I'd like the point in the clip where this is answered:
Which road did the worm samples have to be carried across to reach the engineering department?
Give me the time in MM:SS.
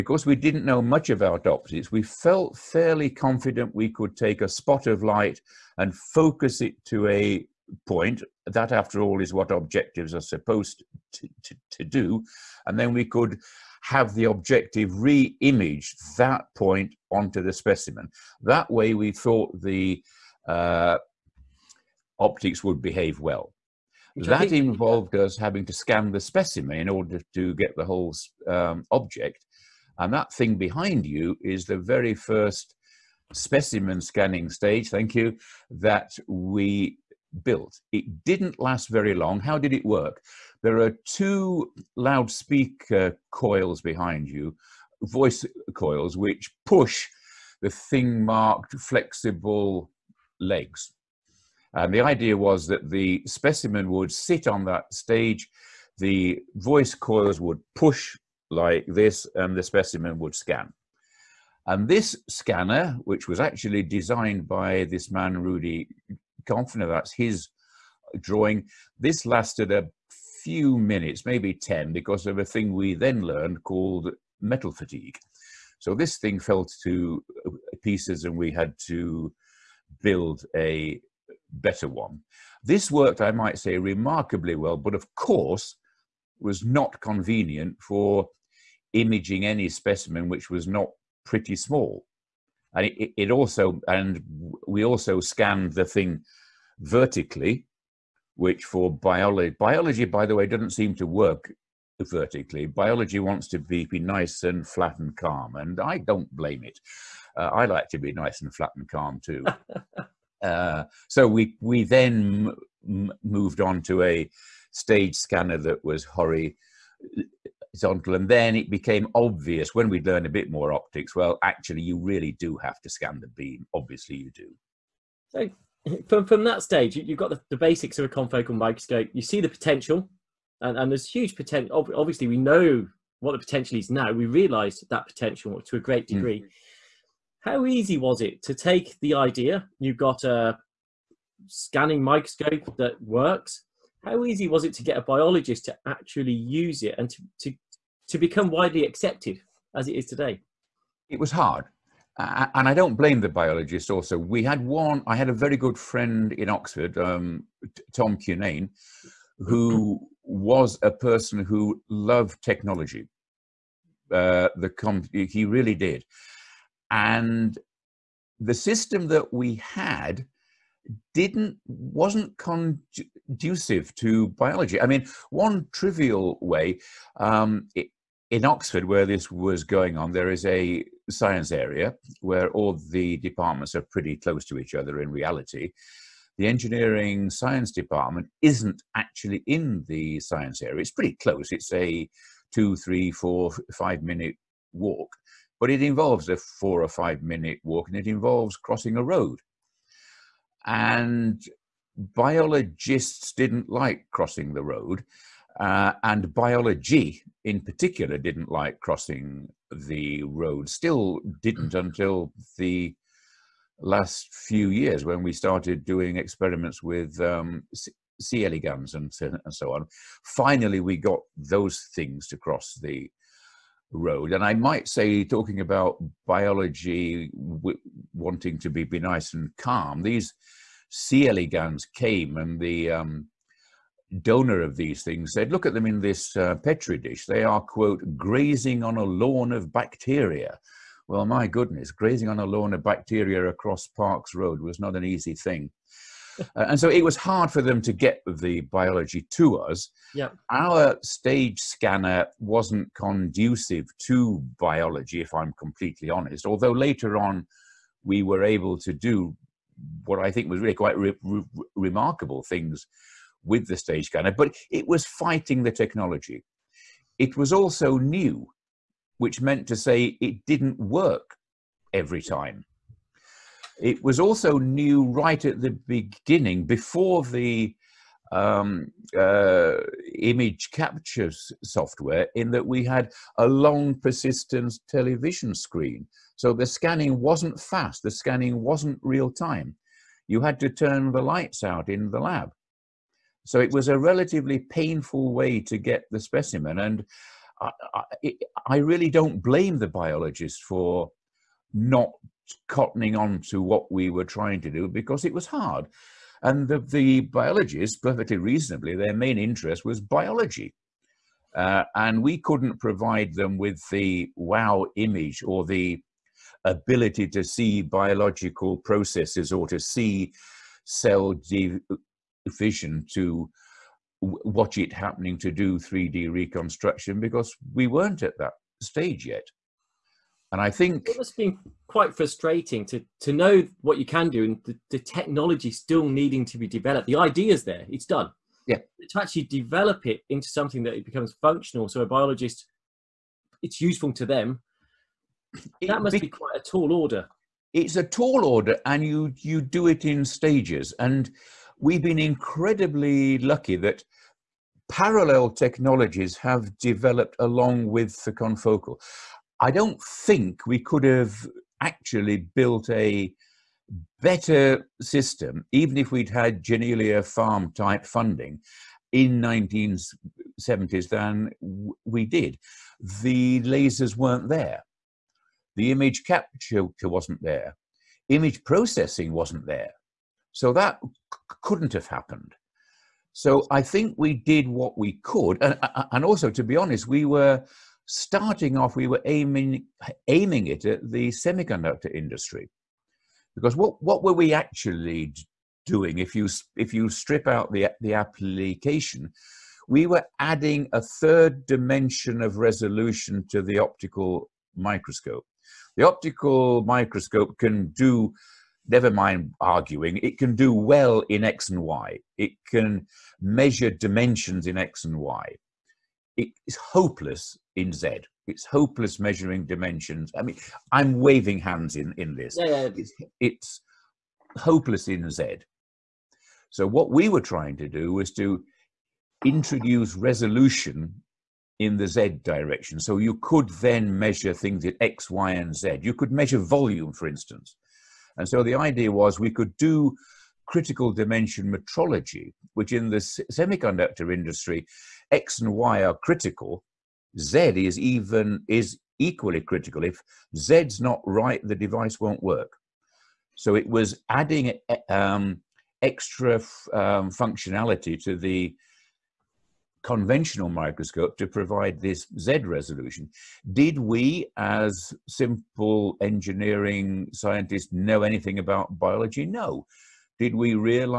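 04:03.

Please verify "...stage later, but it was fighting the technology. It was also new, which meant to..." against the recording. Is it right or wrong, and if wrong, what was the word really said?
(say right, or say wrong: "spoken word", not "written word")
wrong: "scanner", not "later".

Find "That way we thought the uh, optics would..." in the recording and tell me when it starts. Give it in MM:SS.
00:18.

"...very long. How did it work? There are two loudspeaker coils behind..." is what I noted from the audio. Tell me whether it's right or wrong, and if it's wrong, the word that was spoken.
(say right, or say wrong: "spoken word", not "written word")
right.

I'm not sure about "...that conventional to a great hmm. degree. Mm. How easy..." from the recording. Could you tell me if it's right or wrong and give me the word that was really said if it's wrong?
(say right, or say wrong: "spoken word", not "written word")
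wrong: "potential", not "conventional".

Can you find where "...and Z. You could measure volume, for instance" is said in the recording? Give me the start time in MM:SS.
07:15.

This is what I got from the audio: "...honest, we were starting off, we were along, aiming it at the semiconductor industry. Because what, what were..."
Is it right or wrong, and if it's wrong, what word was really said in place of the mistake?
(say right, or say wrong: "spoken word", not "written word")
wrong: "aiming", not "along".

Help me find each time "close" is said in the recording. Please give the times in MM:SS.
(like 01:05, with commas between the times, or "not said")
03:04, 03:11.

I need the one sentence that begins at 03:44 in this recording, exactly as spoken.
And I might say, talking about biology wanting to be, be nice and calm, these C.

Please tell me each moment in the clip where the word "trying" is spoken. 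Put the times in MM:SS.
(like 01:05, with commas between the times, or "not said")
05:04, 07:07.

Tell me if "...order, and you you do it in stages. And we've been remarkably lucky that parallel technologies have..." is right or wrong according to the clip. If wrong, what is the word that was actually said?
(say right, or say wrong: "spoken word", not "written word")
wrong: "incredibly", not "remarkably".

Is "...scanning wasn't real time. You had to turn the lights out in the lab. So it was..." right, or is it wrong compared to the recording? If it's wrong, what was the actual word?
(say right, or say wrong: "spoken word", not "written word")
right.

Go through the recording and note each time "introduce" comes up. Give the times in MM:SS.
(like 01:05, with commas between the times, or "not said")
07:09.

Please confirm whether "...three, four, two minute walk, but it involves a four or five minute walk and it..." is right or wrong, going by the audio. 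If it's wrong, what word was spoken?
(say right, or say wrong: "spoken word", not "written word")
wrong: "five", not "two".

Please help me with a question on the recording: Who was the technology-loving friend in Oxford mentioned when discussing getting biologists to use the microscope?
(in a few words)
Tom Cunane.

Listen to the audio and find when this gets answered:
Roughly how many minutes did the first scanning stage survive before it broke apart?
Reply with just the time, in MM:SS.
01:11.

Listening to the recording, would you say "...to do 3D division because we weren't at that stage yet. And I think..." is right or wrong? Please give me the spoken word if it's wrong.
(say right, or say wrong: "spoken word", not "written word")
wrong: "reconstruction", not "division".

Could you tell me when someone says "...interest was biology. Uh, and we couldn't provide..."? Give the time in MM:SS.
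05:09.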